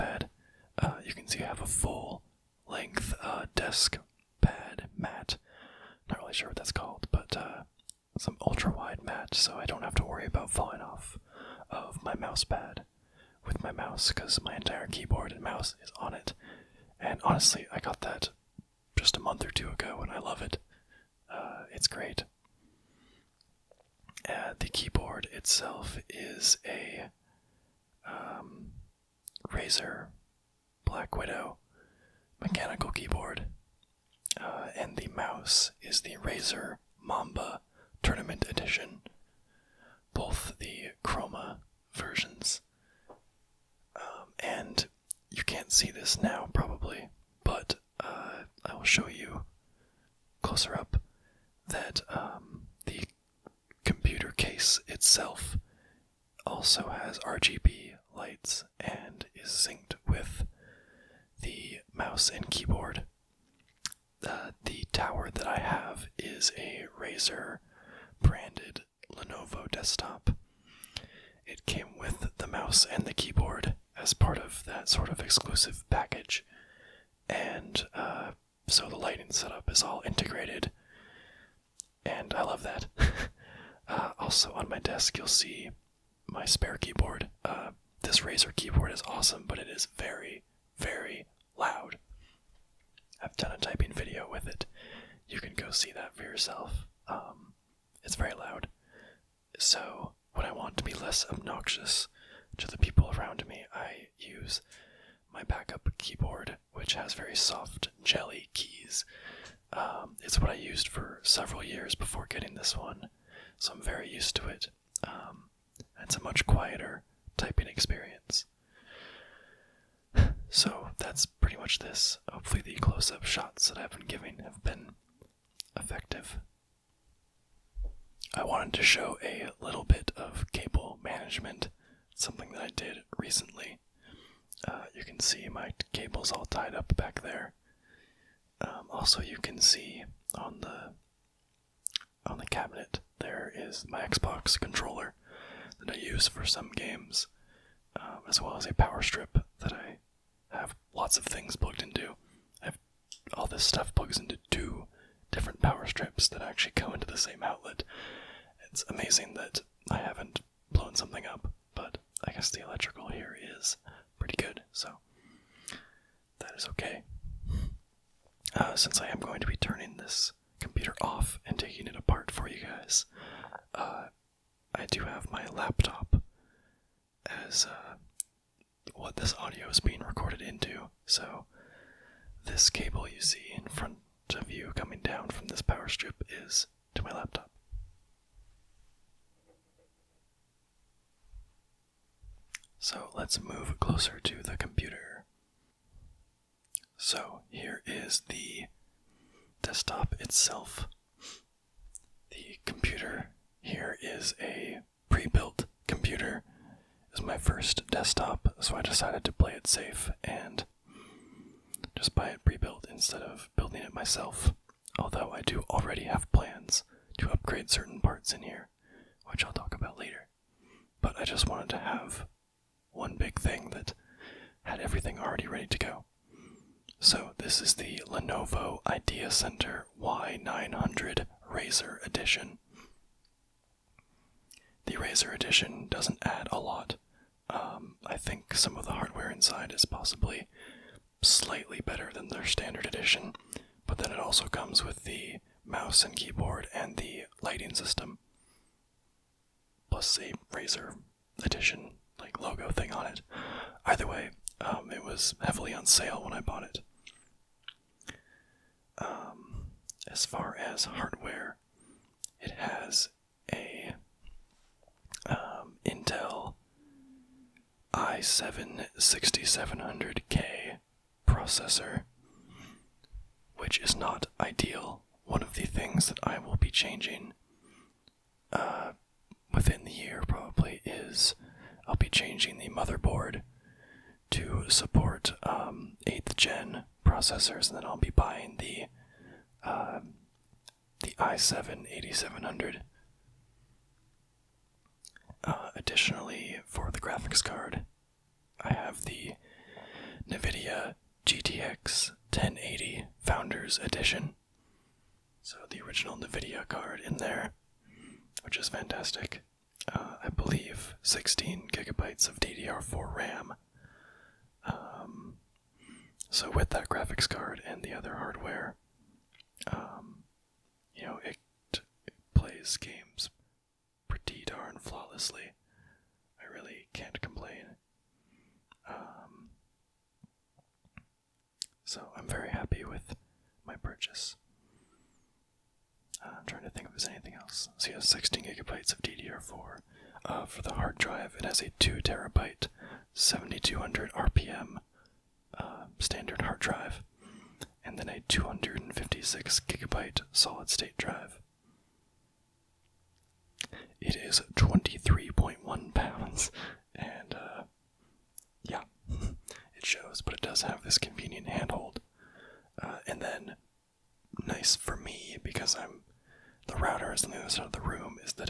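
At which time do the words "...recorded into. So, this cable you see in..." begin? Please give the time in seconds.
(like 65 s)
179 s.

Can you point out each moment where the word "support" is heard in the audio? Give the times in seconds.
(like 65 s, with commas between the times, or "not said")
284 s.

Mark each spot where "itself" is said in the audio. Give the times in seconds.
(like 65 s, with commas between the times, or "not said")
25 s, 54 s, 200 s.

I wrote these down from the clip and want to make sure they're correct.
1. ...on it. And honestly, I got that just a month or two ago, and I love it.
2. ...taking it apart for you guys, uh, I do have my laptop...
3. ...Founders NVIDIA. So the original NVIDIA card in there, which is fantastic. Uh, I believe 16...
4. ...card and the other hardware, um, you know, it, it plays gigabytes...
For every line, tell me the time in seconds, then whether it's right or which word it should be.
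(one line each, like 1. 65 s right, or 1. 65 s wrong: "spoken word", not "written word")
1. 16 s right
2. 171 s right
3. 303 s wrong: "Edition", not "NVIDIA"
4. 317 s wrong: "games", not "gigabytes".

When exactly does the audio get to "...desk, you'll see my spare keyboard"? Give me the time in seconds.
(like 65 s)
84 s.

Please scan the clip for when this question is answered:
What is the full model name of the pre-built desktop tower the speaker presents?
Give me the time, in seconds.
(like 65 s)
228 s.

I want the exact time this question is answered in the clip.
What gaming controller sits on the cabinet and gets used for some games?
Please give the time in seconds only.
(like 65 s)
144 s.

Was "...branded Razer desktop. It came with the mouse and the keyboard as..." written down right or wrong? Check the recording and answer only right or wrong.
wrong.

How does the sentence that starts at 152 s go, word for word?
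I have all this stuff plugs into two different power strips that actually go into the same outlet.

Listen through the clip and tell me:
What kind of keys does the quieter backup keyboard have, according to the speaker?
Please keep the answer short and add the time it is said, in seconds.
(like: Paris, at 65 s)
soft, jelly keys, at 107 s.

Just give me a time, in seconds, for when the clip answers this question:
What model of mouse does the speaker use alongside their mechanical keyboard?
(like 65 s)
36 s.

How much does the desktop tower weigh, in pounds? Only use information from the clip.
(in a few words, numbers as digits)
23.1.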